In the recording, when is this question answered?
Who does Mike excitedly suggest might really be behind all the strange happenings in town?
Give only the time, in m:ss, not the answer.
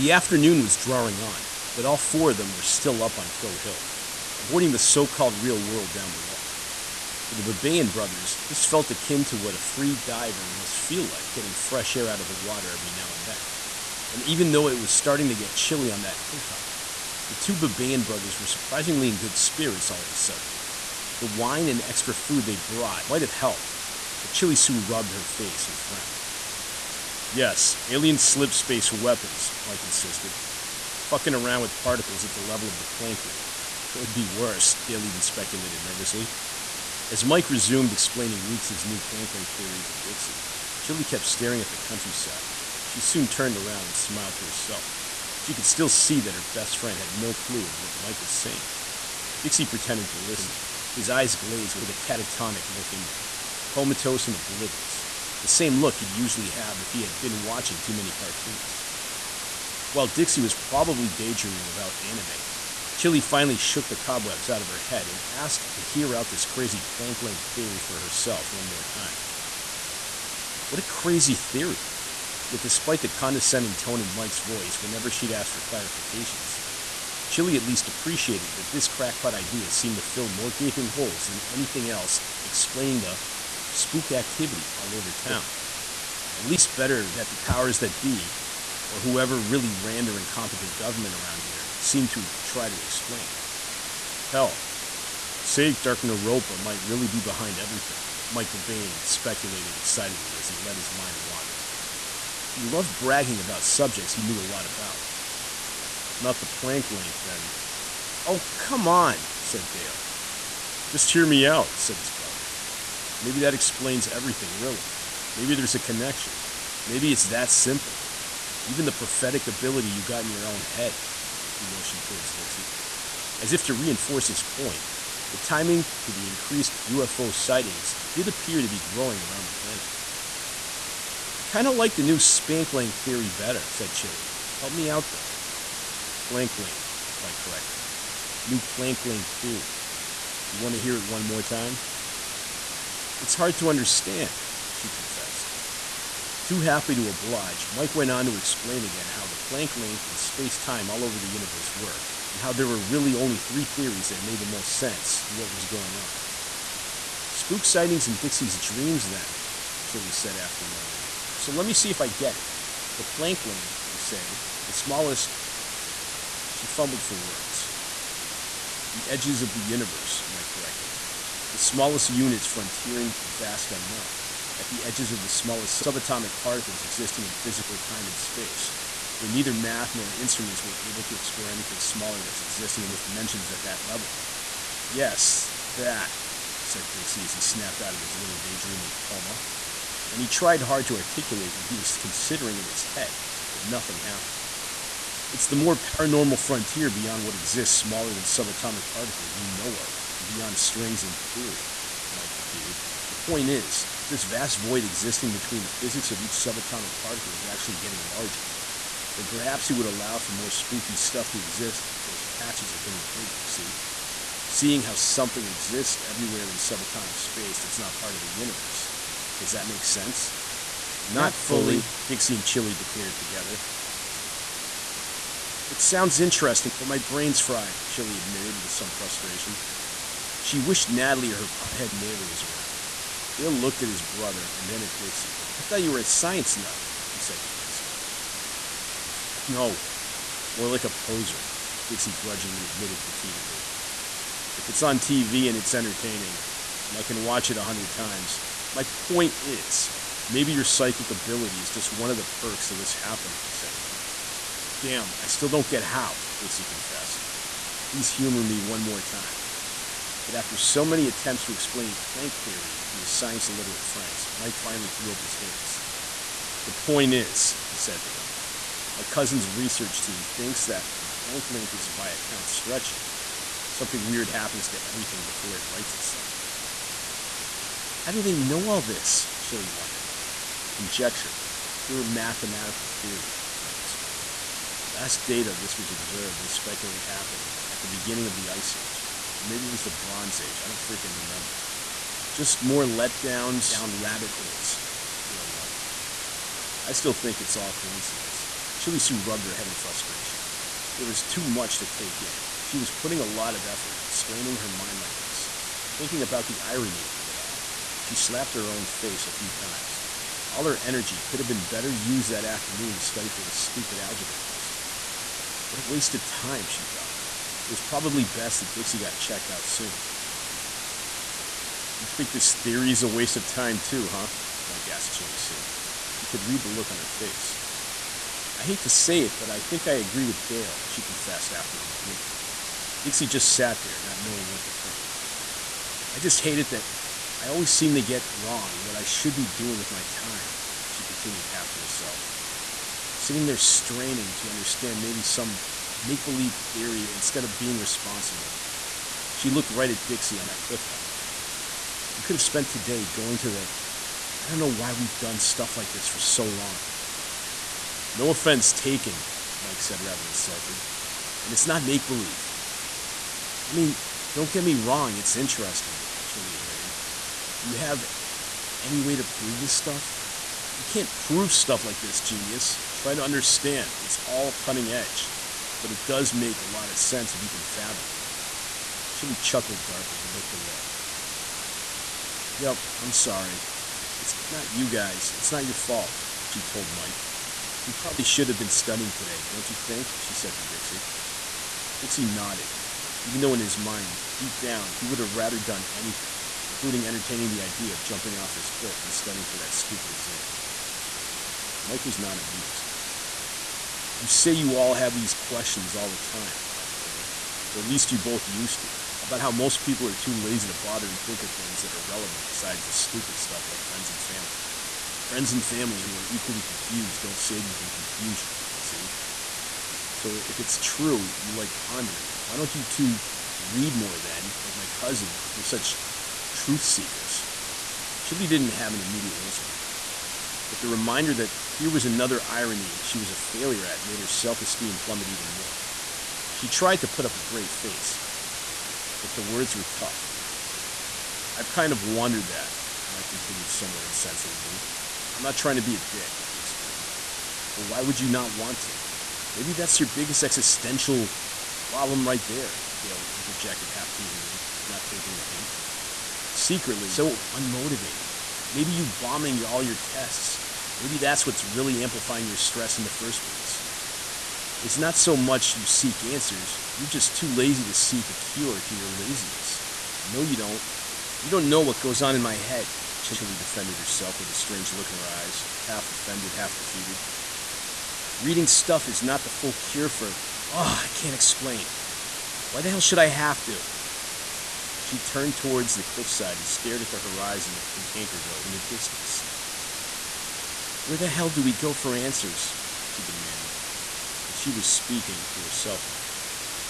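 1:35.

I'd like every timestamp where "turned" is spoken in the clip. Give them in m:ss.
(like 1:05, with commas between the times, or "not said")
0:43, 8:05.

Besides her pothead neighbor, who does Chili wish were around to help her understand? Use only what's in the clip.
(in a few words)
Natalie.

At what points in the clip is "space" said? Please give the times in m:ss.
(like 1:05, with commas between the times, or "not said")
0:28, 2:30, 2:58, 3:37.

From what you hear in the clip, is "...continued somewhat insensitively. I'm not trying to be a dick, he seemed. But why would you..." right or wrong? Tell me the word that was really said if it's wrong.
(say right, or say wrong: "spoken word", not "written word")
wrong: "explained", not "seemed".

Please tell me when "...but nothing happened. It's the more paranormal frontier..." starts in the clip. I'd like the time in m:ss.
3:13.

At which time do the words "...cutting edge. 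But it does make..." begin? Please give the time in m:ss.
6:14.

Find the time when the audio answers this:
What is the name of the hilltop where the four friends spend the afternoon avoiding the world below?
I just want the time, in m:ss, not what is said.
0:03.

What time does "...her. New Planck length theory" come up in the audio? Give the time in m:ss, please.
2:17.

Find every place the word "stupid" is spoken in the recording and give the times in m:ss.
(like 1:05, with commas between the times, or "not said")
5:13, 6:39, 6:52.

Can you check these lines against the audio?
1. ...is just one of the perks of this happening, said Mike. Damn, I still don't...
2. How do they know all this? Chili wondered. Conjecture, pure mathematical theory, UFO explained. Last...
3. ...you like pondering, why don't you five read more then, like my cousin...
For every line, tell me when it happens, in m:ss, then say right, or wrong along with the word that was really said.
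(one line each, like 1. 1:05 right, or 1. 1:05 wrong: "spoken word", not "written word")
1. 4:11 right
2. 4:37 wrong: "Mike", not "UFO"
3. 7:01 wrong: "two", not "five".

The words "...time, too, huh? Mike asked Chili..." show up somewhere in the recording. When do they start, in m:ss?
5:23.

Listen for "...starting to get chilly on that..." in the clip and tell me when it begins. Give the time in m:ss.
0:14.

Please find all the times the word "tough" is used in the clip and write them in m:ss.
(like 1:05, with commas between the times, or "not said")
7:19.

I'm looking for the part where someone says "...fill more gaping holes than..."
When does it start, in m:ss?
1:20.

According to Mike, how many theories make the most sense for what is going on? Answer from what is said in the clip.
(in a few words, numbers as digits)
3.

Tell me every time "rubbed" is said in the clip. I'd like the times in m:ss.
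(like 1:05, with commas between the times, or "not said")
0:24, 4:59.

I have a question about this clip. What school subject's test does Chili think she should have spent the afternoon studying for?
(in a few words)
Algebra.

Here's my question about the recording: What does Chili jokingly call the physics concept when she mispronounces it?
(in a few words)
Spank length.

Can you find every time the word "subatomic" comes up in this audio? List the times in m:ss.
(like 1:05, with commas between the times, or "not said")
2:55, 3:18, 3:26, 3:36.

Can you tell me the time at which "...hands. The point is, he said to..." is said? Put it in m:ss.
4:25.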